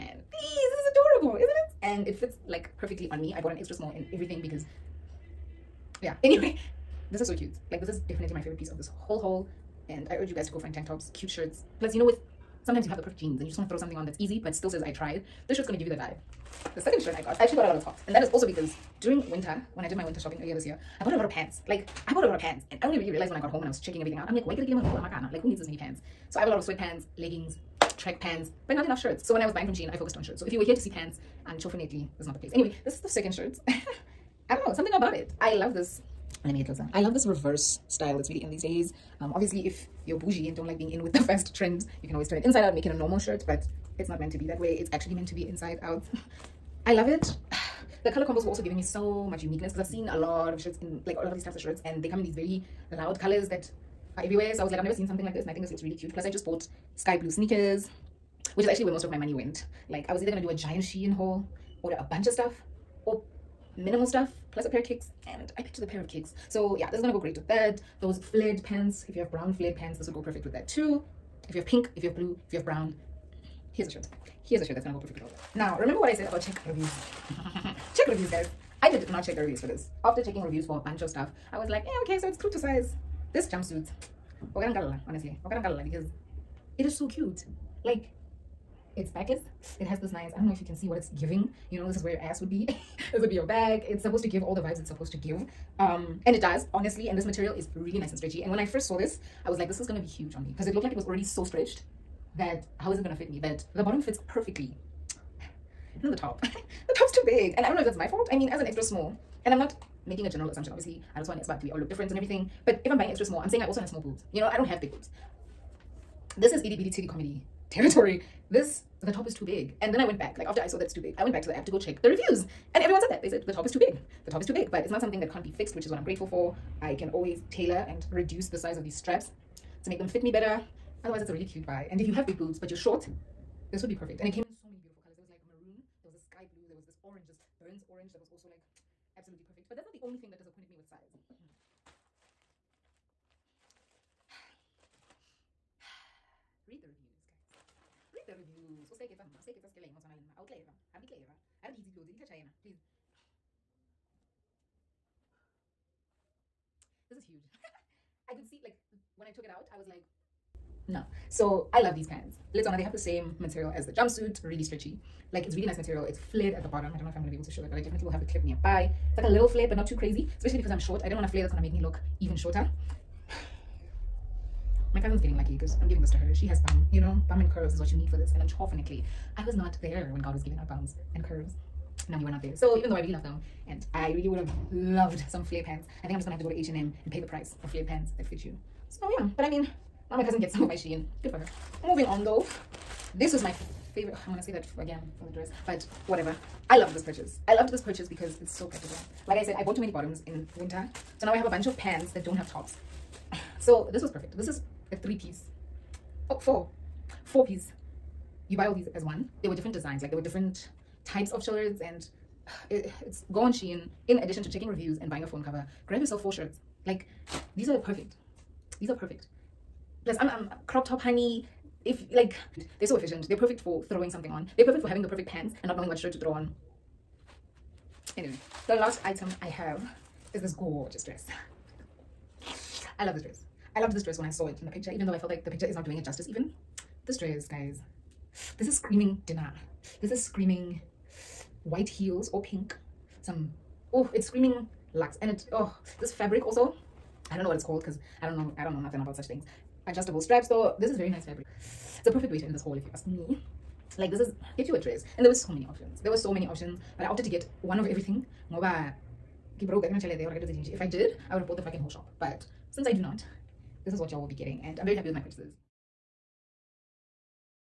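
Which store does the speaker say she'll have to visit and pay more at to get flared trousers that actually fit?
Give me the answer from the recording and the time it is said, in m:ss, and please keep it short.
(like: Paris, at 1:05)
H&M, at 3:06.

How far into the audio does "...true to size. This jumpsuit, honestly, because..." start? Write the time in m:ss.
1:22.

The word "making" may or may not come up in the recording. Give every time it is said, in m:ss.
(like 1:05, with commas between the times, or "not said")
1:50.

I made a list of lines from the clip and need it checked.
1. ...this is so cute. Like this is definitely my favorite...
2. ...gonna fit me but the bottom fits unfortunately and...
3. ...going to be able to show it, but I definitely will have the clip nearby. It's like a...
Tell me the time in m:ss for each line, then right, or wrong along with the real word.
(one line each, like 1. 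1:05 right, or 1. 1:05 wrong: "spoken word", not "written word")
1. 0:07 right
2. 1:43 wrong: "perfectly", not "unfortunately"
3. 2:47 right.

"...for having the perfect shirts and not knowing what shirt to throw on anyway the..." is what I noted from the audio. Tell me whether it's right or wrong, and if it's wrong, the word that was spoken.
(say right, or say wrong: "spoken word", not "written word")
wrong: "pants", not "shirts".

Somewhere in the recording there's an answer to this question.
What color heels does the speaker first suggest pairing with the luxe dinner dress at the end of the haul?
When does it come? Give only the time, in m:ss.
4:01.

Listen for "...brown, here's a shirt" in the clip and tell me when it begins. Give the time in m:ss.
1:12.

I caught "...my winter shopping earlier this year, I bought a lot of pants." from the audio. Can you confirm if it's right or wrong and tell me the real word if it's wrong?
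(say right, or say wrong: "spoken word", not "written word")
right.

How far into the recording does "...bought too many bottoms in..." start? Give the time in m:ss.
3:19.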